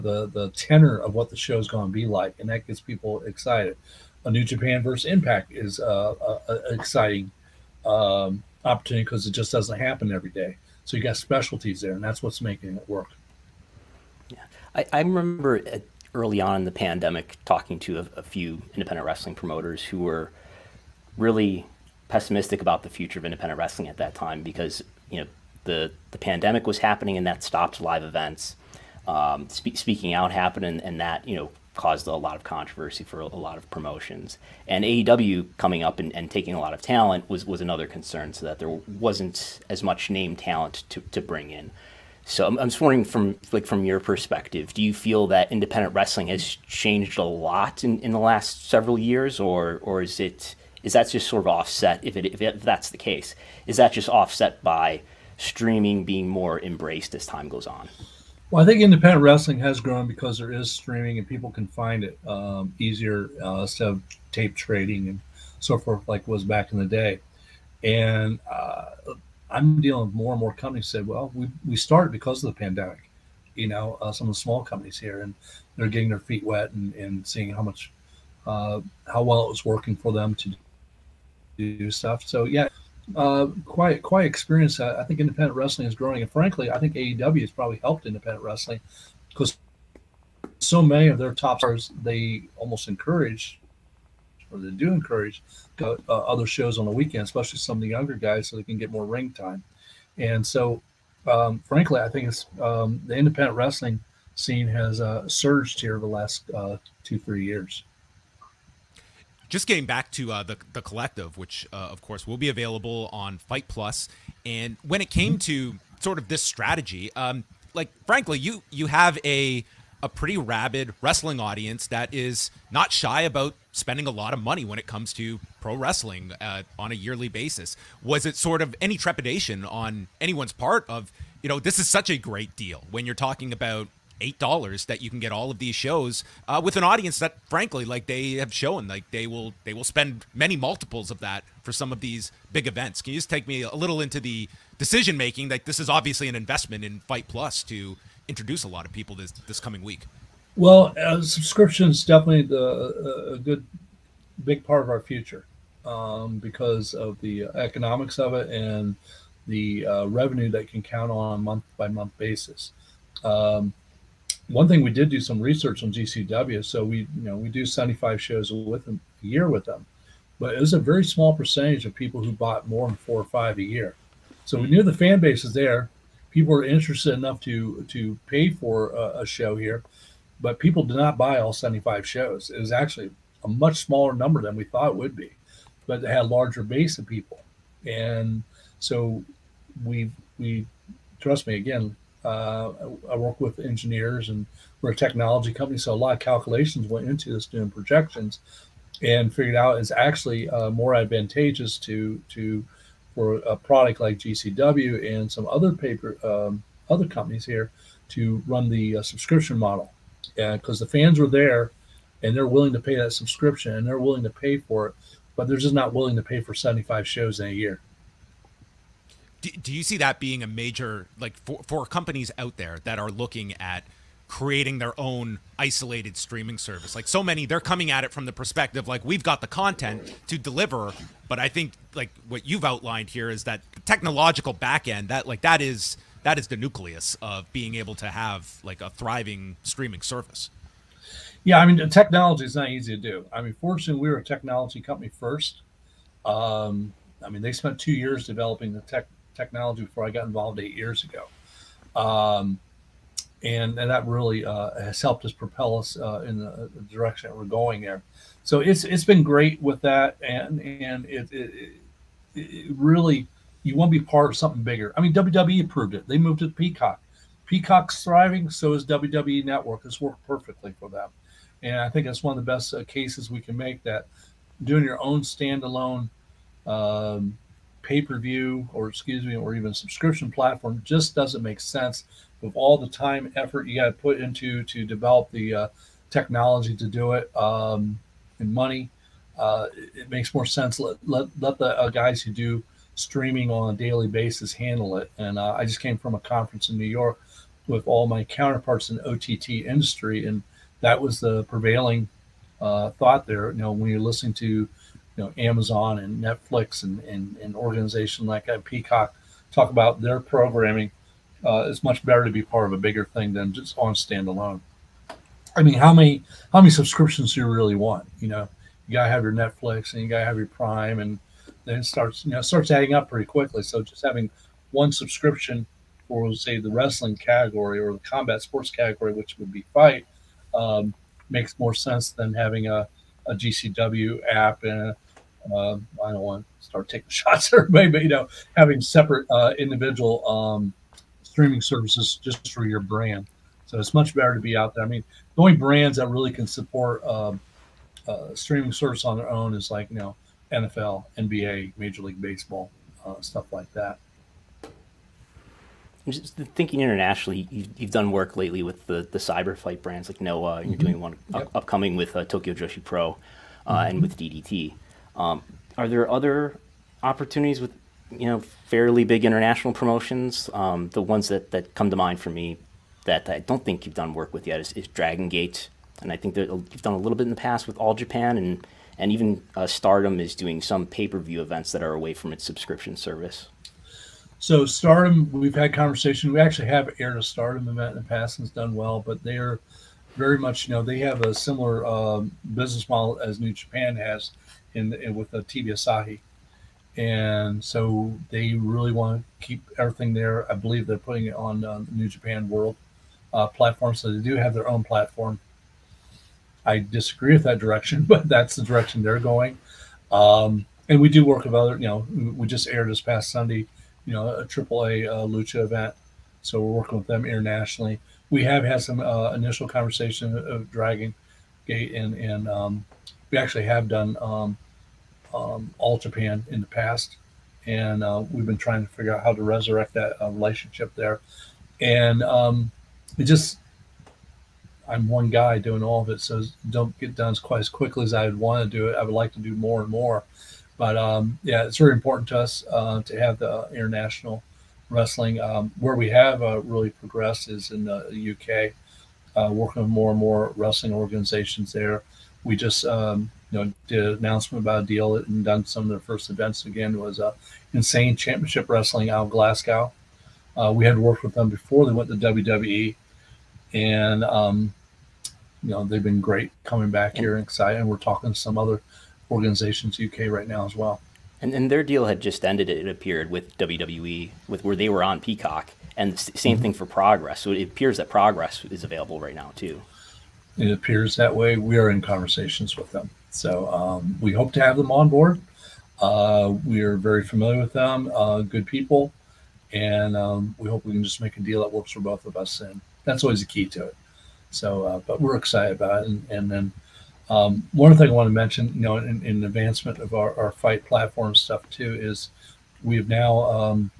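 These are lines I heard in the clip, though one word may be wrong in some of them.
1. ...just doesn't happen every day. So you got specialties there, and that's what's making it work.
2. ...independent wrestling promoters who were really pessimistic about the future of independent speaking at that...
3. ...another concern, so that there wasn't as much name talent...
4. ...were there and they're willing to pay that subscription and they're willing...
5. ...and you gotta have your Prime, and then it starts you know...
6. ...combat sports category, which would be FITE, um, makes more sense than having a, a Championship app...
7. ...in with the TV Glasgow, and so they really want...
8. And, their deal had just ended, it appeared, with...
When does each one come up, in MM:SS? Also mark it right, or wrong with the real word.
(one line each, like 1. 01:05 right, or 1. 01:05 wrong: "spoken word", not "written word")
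1. 00:09 right
2. 00:18 wrong: "wrestling", not "speaking"
3. 00:37 right
4. 03:31 right
5. 05:19 right
6. 05:27 wrong: "GCW", not "Championship"
7. 06:34 wrong: "Asahi", not "Glasgow"
8. 07:51 right.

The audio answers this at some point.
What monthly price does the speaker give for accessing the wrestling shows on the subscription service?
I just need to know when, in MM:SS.
02:14.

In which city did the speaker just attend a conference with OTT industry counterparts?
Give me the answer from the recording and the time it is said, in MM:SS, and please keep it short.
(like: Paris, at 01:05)
New York, at 04:56.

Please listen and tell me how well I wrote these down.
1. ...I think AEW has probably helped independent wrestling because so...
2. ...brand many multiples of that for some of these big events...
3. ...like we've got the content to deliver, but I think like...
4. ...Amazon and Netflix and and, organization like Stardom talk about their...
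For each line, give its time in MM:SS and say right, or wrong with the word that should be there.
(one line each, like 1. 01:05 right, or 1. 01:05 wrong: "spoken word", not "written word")
1. 01:26 right
2. 02:19 wrong: "spend", not "brand"
3. 03:48 right
4. 05:05 wrong: "Peacock", not "Stardom".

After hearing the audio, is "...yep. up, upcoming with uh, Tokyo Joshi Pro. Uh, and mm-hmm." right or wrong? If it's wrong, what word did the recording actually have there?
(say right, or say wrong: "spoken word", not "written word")
right.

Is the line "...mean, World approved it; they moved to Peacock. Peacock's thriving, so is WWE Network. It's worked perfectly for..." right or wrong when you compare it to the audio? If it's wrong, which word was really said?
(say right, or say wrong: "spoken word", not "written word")
wrong: "WWE", not "World".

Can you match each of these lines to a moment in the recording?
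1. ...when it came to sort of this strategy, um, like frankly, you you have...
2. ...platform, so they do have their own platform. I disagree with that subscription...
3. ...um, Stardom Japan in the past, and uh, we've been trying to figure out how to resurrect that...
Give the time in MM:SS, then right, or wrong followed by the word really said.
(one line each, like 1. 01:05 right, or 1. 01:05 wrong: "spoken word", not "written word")
1. 01:54 right
2. 06:43 wrong: "direction", not "subscription"
3. 07:05 wrong: "All", not "Stardom".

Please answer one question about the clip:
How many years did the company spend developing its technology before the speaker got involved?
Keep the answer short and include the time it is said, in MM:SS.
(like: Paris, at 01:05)
2 years, at 04:07.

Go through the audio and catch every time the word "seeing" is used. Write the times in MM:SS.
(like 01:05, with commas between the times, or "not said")
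01:17.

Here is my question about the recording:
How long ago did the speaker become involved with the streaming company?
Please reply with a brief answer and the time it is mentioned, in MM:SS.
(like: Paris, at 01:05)
8 years ago, at 04:10.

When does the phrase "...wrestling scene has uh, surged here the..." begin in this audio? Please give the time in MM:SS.
01:43.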